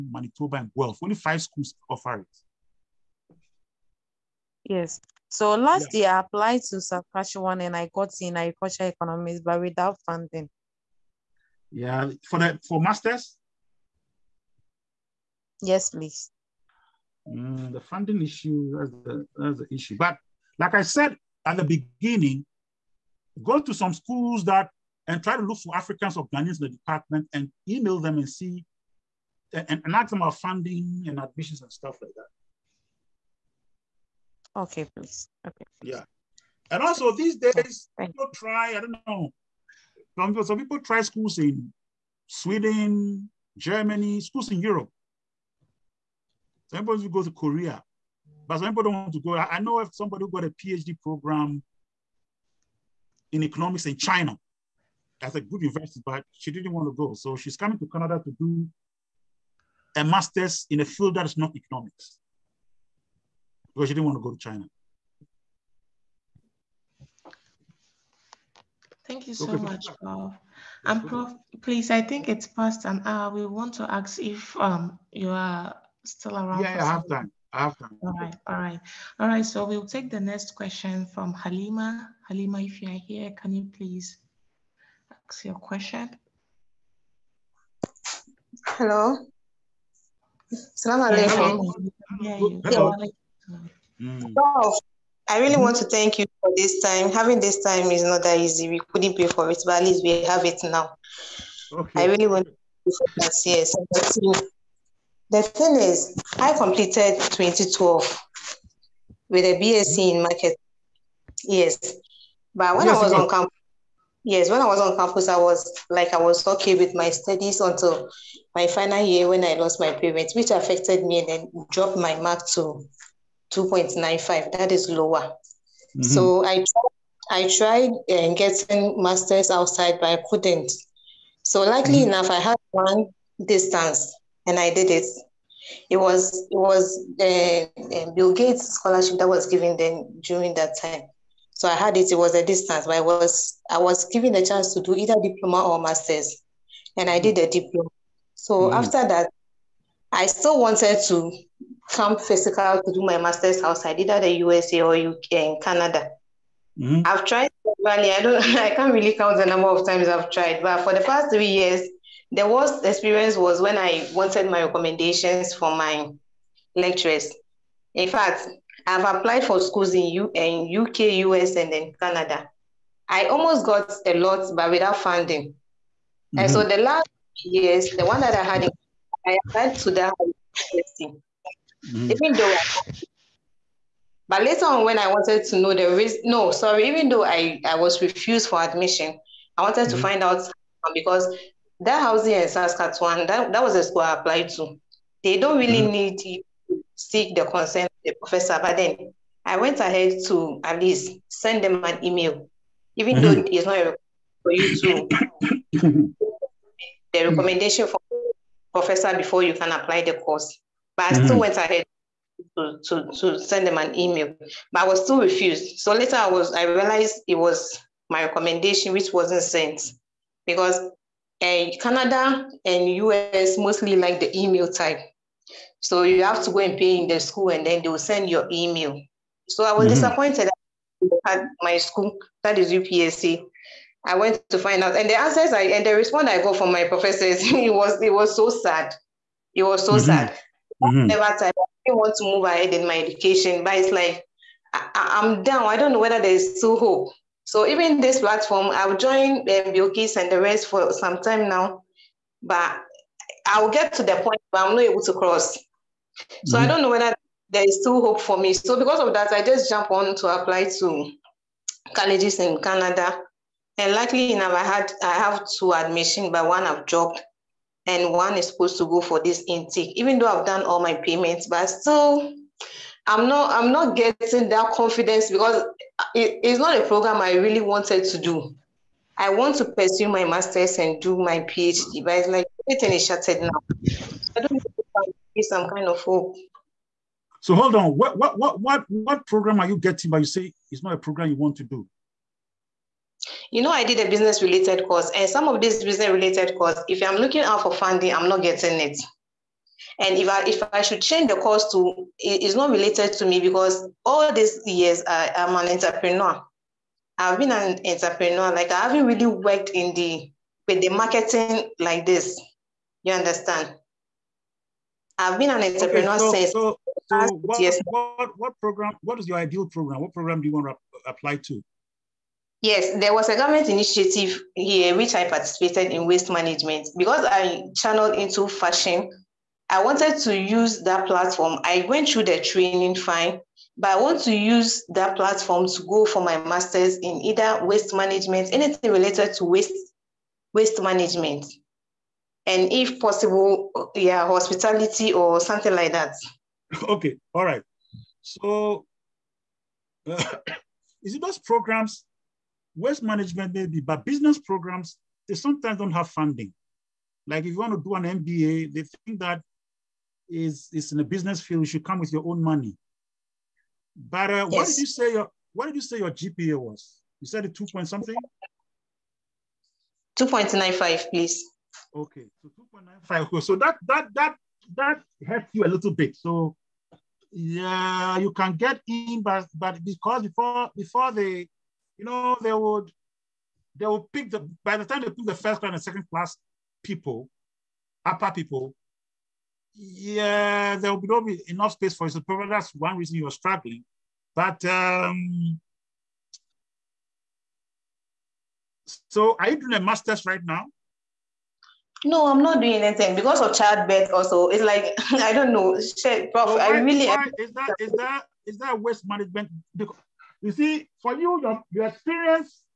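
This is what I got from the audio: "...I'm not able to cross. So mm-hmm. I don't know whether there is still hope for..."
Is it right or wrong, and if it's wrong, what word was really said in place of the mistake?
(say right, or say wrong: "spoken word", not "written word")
right.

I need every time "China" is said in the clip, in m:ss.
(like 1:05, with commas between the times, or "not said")
0:53, 1:04.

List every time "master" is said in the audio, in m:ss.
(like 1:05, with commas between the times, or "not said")
0:12, 1:00, 2:09, 2:25, 2:33, 4:40, 5:36, 6:39.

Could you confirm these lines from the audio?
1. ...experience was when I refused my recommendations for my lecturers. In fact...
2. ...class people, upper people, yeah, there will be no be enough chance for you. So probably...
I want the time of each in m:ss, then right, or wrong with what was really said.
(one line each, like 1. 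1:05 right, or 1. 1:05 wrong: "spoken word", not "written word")
1. 2:42 wrong: "wanted", not "refused"
2. 6:26 wrong: "space", not "chance".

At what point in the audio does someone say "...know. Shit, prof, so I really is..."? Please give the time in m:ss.
6:45.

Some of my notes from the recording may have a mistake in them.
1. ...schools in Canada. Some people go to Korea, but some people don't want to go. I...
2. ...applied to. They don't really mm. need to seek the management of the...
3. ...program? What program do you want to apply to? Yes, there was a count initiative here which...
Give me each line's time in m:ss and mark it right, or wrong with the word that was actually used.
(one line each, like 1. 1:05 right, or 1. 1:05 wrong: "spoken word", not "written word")
1. 0:44 wrong: "Europe", not "Canada"
2. 3:14 wrong: "consent", not "management"
3. 5:19 wrong: "government", not "count".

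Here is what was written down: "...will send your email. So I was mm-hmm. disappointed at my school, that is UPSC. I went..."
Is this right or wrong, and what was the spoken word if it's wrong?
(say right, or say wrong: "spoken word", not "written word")
right.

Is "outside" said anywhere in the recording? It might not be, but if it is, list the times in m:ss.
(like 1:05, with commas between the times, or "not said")
2:09, 2:33.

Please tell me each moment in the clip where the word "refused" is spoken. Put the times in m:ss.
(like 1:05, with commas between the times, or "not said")
3:08, 3:35.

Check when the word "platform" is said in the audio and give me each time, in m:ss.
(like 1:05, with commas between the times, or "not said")
4:08, 5:31, 5:35.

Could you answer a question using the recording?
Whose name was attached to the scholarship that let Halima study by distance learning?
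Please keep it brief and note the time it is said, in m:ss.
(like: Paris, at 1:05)
Bill Gates, at 2:18.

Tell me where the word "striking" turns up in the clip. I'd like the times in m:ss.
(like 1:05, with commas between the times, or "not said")
not said.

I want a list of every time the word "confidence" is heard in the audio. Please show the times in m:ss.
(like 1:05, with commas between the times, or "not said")
4:34.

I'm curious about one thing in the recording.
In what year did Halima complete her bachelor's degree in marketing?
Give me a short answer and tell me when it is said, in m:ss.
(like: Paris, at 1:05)
2012, at 1:47.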